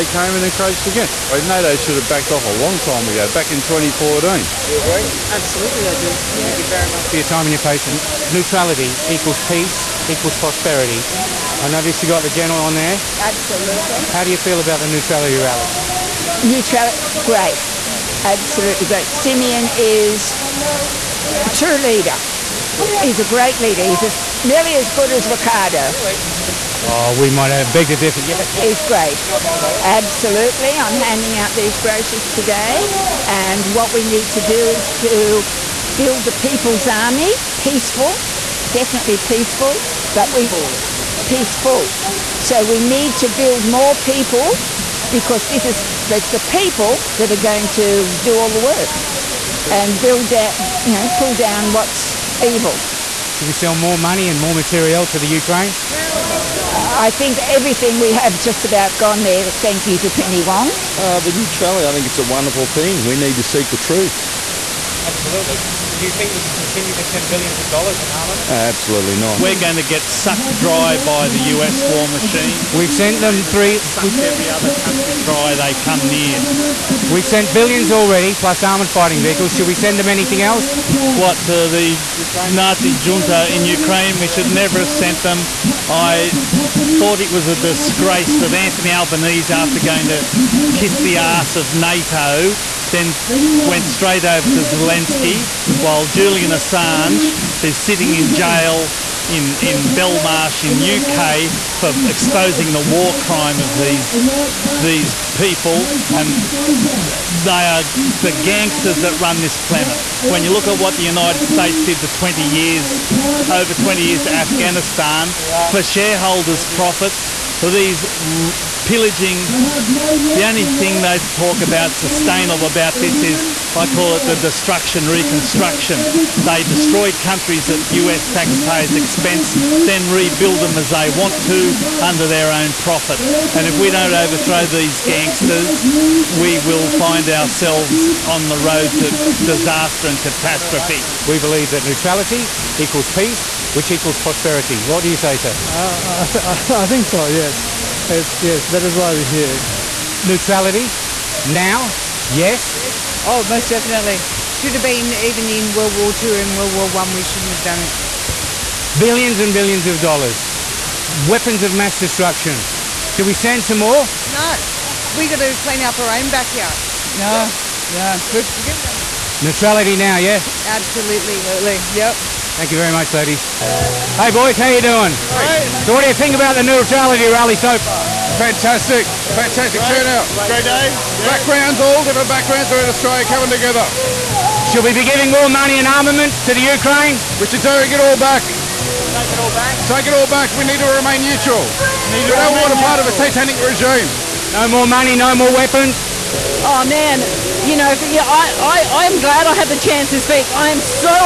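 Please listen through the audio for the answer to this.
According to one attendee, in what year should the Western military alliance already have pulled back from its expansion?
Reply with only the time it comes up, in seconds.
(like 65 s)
3 s.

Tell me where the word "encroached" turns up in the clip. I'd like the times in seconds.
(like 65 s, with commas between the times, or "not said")
0 s.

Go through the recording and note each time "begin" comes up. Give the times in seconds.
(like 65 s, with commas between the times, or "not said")
not said.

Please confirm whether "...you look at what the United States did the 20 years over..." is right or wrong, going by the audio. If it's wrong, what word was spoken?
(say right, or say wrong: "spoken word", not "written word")
right.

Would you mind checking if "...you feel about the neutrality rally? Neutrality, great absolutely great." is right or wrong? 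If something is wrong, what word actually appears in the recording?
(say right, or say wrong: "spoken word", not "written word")
right.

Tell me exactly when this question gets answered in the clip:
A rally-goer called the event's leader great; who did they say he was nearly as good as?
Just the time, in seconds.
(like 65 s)
25 s.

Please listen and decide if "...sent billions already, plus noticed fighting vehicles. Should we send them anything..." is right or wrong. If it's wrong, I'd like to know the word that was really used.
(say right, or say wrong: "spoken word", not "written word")
wrong: "armoured", not "noticed".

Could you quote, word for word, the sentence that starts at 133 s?
And if we don't overthrow these gangsters, we will find ourselves on the road to disaster and catastrophe.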